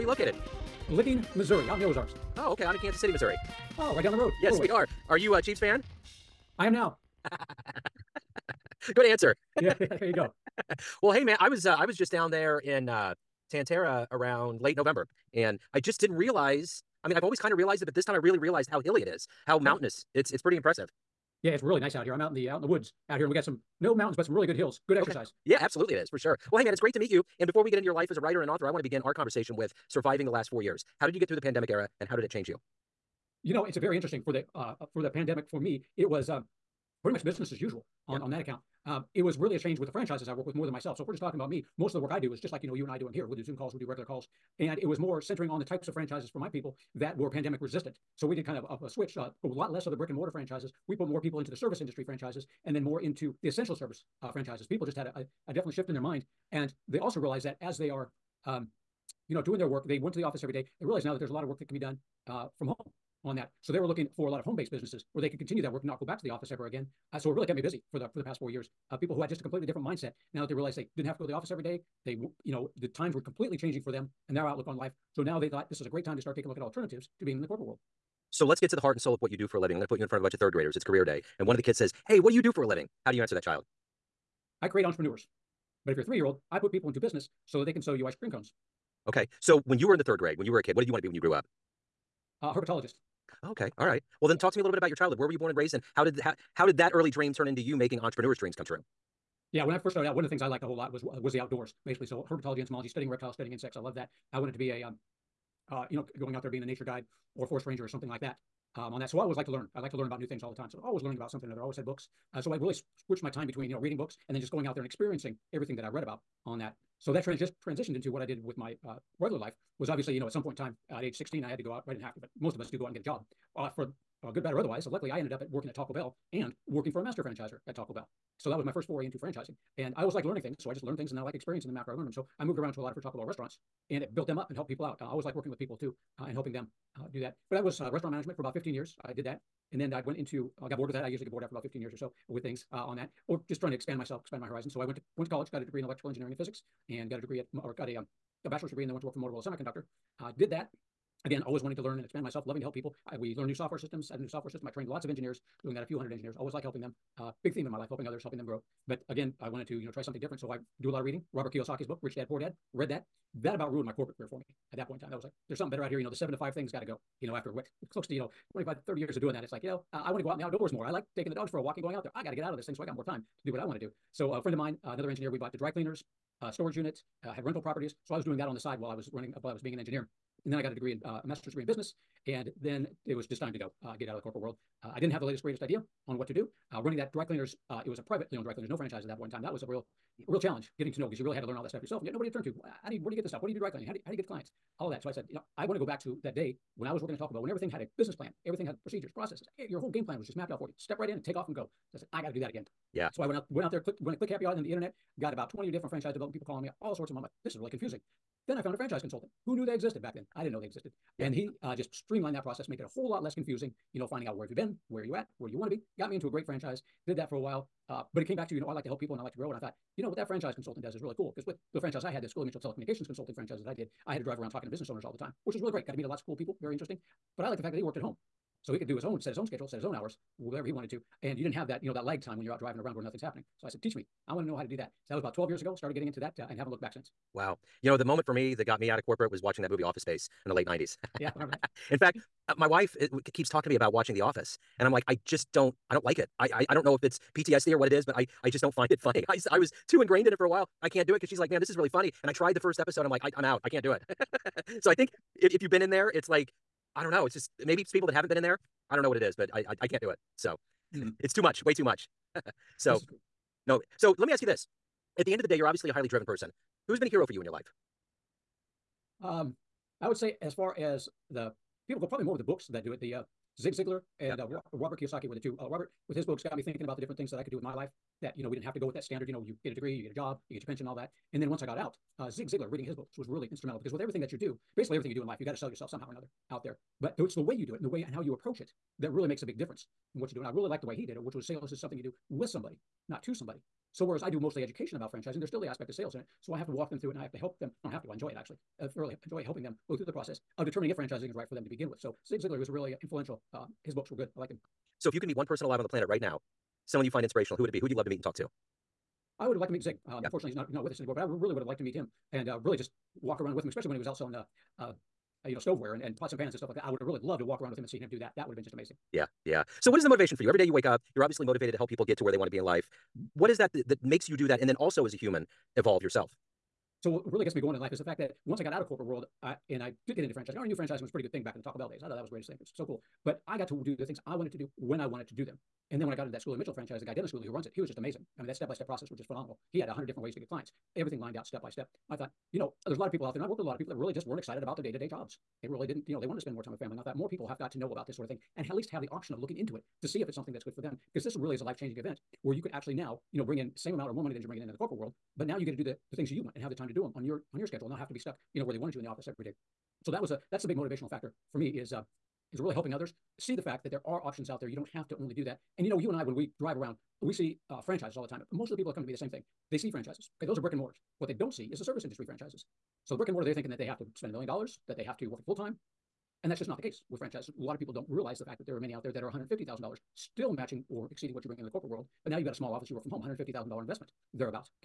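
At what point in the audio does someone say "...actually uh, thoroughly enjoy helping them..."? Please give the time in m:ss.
4:58.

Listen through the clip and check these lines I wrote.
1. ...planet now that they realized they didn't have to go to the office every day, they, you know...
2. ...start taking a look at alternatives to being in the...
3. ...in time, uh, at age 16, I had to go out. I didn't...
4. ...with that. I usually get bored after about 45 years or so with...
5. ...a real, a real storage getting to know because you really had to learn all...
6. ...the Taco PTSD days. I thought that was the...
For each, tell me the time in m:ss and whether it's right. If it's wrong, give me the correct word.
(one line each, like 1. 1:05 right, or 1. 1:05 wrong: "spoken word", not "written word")
1. 1:09 wrong: "mindset", not "planet"
2. 1:16 right
3. 2:00 right
4. 2:20 wrong: "15", not "45"
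5. 3:09 wrong: "challenge", not "storage"
6. 5:31 wrong: "Bell", not "PTSD".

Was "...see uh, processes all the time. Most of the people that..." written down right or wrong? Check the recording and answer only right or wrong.
wrong.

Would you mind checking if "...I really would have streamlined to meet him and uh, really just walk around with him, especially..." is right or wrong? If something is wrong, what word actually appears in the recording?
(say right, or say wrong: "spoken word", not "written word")
wrong: "liked", not "streamlined".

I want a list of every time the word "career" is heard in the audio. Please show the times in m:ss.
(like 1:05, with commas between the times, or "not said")
1:20, 2:44.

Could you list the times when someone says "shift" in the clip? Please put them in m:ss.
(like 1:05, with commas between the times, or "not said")
0:55.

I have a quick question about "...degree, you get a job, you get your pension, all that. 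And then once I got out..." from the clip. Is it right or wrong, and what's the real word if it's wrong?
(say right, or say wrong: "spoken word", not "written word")
right.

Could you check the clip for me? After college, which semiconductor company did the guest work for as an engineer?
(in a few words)
Motorola Semiconductor.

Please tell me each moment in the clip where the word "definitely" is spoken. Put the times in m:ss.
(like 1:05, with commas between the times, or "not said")
0:55.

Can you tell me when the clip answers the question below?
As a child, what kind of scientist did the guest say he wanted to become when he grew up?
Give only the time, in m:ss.
1:32.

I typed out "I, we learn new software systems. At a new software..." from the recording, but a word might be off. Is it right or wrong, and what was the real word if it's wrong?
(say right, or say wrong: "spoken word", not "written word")
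right.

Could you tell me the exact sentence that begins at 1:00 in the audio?
They realize now that there's a lot of work that can be done uh, from home on that.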